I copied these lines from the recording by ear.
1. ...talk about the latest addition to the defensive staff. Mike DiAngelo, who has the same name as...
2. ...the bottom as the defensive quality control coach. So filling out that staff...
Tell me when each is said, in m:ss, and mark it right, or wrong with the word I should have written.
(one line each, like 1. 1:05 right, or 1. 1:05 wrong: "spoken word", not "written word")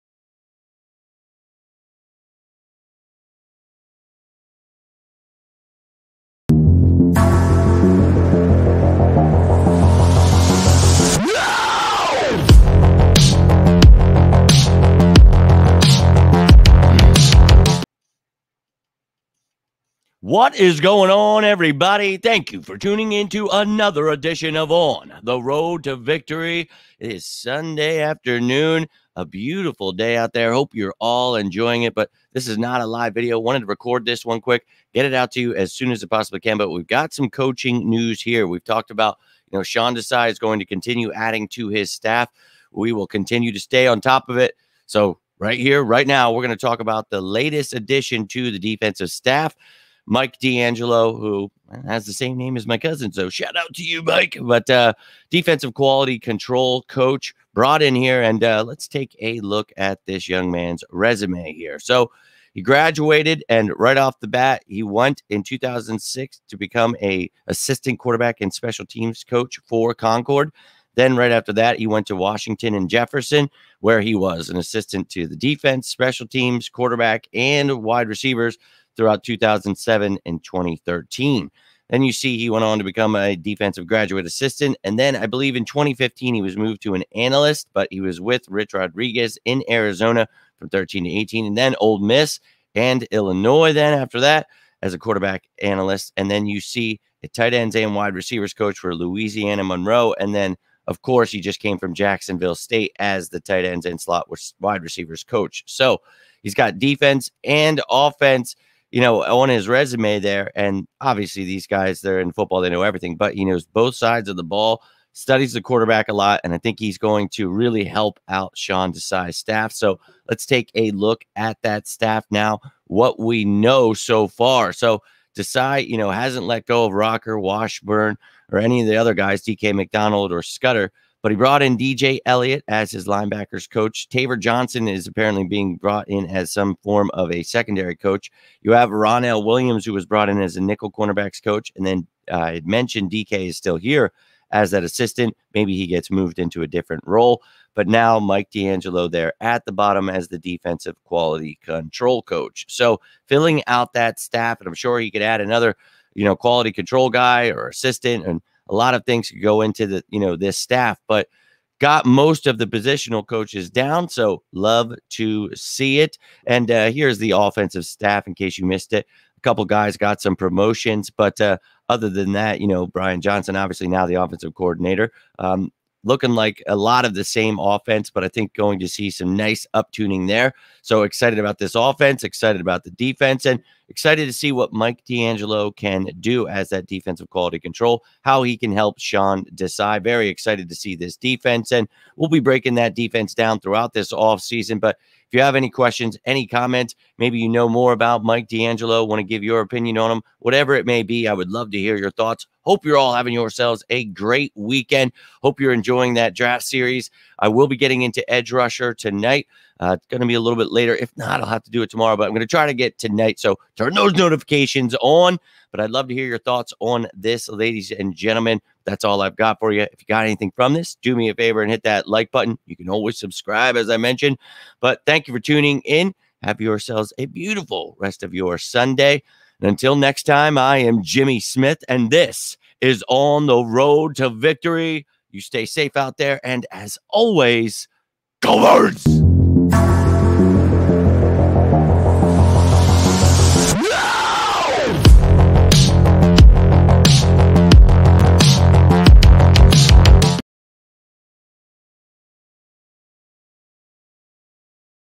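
1. 0:46 right
2. 2:29 right.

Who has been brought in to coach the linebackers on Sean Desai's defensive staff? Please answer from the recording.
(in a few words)
DJ Elliott.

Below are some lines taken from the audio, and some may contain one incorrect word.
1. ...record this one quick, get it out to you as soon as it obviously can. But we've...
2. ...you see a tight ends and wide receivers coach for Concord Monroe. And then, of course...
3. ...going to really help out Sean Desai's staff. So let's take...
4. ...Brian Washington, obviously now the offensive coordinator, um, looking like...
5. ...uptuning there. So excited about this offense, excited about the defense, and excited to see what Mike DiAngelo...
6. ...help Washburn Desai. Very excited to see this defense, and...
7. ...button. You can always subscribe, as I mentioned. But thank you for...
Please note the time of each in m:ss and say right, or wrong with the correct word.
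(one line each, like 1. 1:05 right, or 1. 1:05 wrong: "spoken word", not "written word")
1. 0:33 wrong: "possibly", not "obviously"
2. 1:36 wrong: "Louisiana", not "Concord"
3. 1:56 right
4. 2:52 wrong: "Johnson", not "Washington"
5. 2:59 right
6. 3:08 wrong: "Sean", not "Washburn"
7. 3:42 right.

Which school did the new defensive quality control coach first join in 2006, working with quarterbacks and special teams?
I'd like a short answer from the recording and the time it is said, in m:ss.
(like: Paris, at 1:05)
Concord, at 1:09.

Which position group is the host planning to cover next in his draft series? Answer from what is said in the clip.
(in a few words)
Edge Rusher.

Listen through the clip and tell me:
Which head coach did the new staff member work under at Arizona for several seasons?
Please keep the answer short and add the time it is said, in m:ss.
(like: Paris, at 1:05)
Rich Rodriguez, at 1:28.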